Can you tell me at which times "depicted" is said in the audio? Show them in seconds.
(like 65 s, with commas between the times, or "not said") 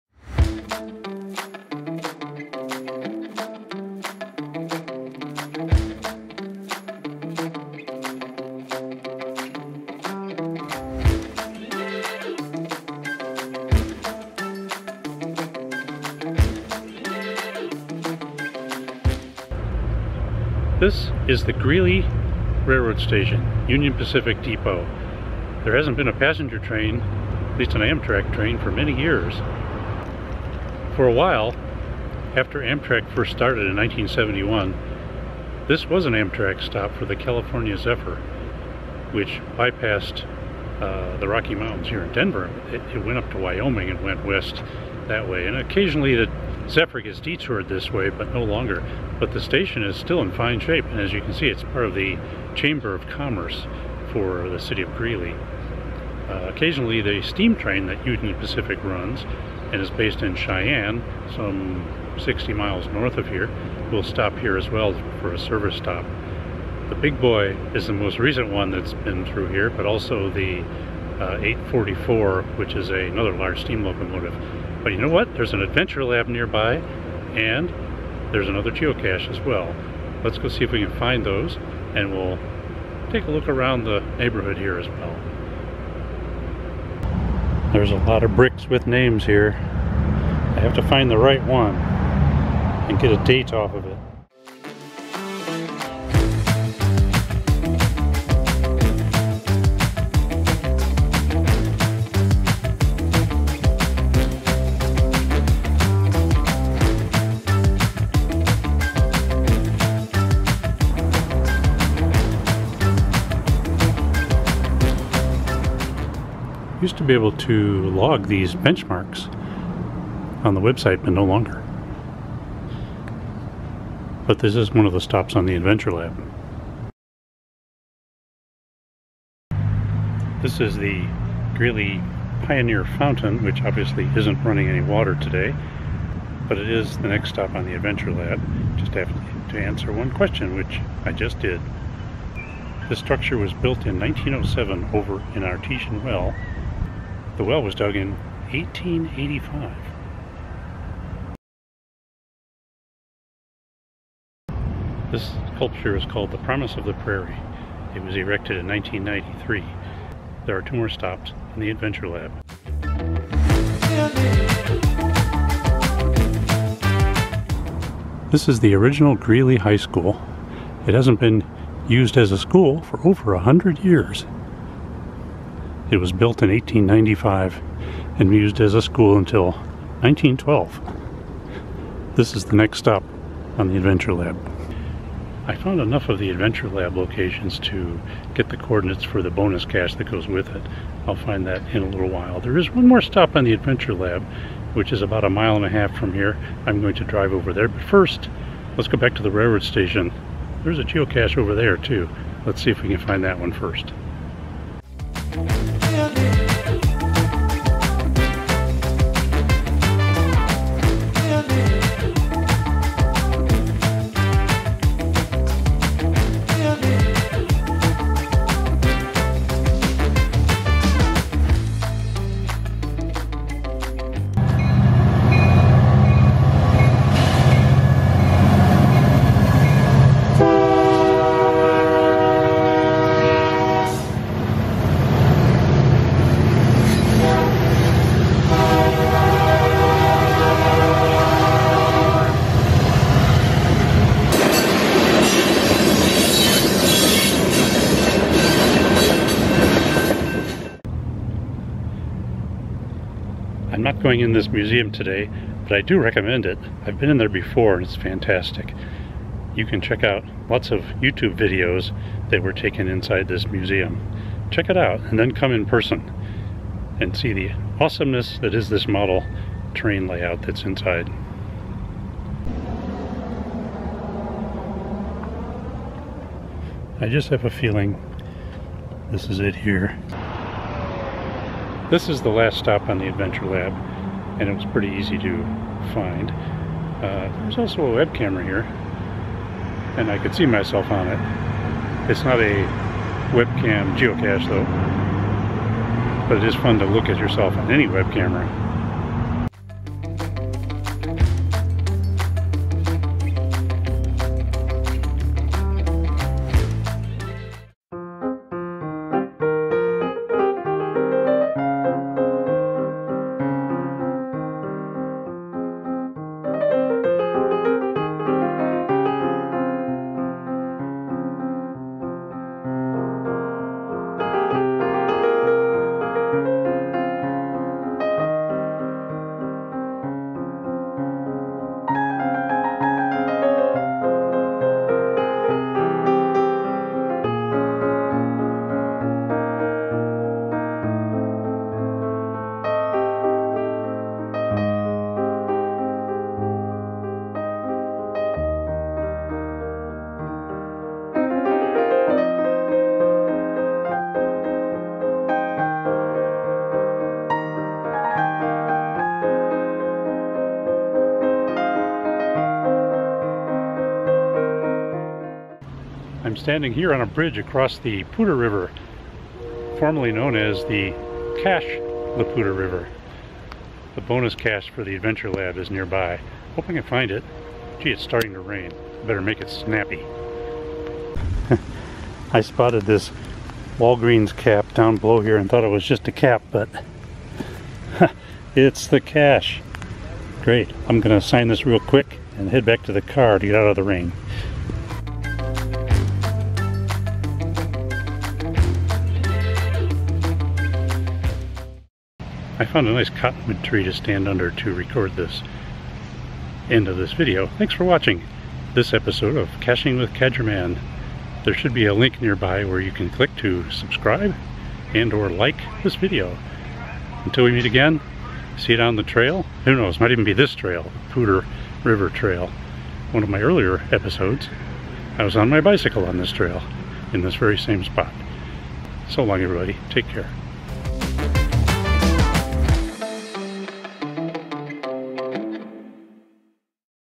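not said.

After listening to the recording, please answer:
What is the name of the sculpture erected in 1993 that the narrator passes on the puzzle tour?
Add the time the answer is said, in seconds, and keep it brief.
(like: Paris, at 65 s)
The Promise of the Prairie, at 156 s.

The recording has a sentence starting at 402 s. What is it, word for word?
I found a nice cottonwood tree to stand under to record this end of this video.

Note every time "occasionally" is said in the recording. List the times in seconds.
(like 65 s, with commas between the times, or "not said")
45 s, 56 s.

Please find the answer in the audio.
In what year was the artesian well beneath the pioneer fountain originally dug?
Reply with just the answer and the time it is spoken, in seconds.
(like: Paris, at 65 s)
1885, at 148 s.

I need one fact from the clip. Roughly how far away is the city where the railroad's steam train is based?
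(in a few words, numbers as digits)
60 miles.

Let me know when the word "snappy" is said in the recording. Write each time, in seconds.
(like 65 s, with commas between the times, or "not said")
379 s.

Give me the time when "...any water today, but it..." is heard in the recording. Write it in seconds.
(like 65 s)
134 s.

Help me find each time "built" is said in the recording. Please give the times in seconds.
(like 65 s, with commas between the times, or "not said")
143 s, 176 s.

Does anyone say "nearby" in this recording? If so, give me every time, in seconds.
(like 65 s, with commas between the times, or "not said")
76 s, 375 s, 412 s.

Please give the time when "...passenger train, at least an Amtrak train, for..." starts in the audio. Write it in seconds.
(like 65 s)
26 s.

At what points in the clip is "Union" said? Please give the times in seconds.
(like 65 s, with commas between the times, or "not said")
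23 s, 58 s.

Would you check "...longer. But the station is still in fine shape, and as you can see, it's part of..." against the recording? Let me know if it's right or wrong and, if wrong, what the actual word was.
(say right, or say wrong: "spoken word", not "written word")
right.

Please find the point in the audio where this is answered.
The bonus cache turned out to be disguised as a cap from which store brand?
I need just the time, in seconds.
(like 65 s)
383 s.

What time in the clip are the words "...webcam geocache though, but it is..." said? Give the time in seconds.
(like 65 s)
293 s.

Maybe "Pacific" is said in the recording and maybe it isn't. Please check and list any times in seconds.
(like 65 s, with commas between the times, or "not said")
23 s, 58 s.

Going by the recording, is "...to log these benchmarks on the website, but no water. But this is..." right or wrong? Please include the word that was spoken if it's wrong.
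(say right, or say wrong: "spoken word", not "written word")
wrong: "longer", not "water".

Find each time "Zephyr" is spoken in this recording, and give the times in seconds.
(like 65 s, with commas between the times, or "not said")
37 s, 46 s.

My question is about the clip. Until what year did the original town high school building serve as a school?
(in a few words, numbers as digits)
1912.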